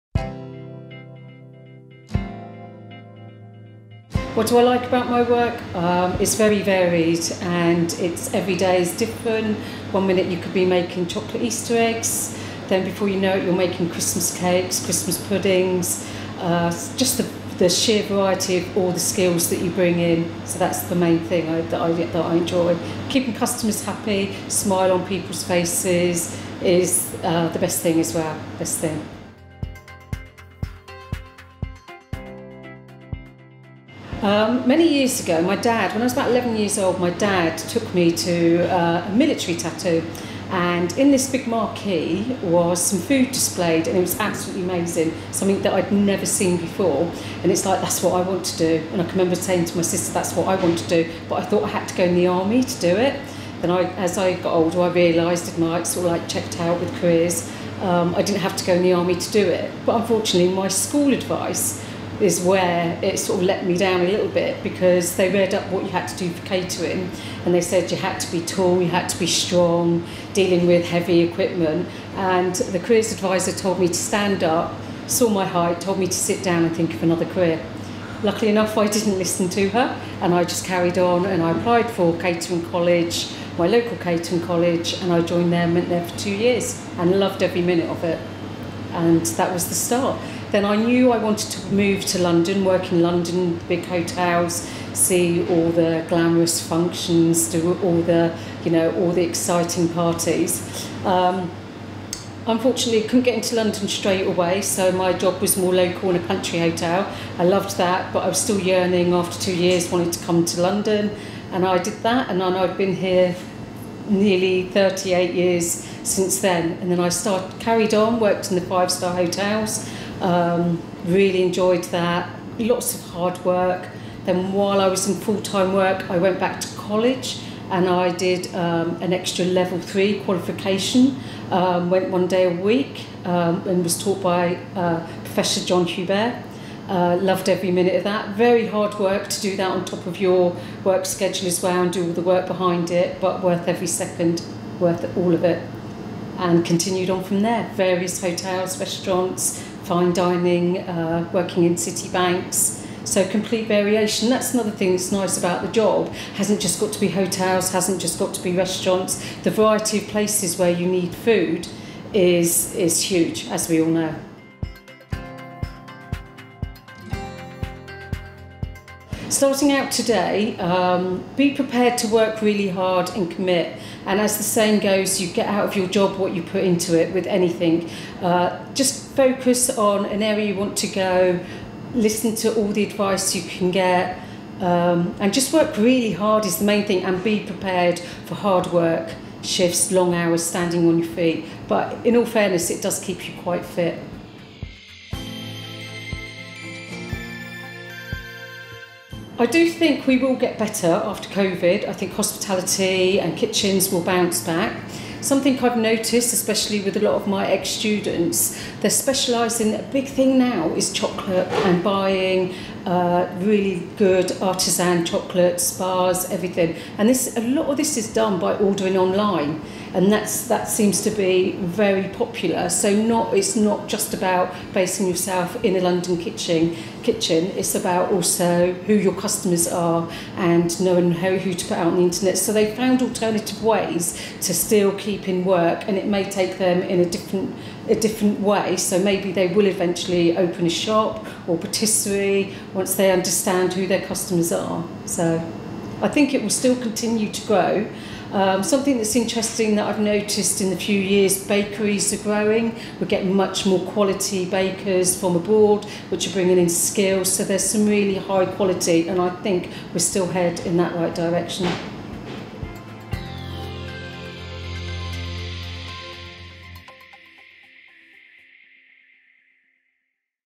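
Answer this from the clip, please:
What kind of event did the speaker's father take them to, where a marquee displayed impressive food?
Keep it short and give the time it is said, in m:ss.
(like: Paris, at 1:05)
military tattoo, at 0:39.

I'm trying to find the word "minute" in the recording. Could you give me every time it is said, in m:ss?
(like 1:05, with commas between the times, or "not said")
0:10, 1:27, 2:17.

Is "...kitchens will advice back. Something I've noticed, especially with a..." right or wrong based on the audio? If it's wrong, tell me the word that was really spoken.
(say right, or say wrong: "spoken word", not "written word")
wrong: "bounce", not "advice".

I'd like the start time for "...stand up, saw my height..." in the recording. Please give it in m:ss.
1:13.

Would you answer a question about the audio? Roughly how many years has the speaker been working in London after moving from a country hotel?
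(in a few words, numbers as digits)
nearly 38 years.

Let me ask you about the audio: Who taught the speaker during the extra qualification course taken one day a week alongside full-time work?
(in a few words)
Professor John Huber.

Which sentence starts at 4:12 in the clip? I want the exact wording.
We're getting much more quality bakers from abroad, which are bringing in skills.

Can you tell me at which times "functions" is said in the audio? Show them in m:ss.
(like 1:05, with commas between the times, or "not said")
1:36.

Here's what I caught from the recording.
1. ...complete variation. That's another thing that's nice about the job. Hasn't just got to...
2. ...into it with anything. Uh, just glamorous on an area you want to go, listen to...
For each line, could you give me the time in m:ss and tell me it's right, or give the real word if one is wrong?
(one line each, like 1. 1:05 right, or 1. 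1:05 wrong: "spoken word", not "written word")
1. 2:33 right
2. 2:56 wrong: "focus", not "glamorous".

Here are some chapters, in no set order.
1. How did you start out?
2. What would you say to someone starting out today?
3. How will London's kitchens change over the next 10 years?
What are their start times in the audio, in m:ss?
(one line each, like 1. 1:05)
1. 0:30
2. 2:45
3. 3:15.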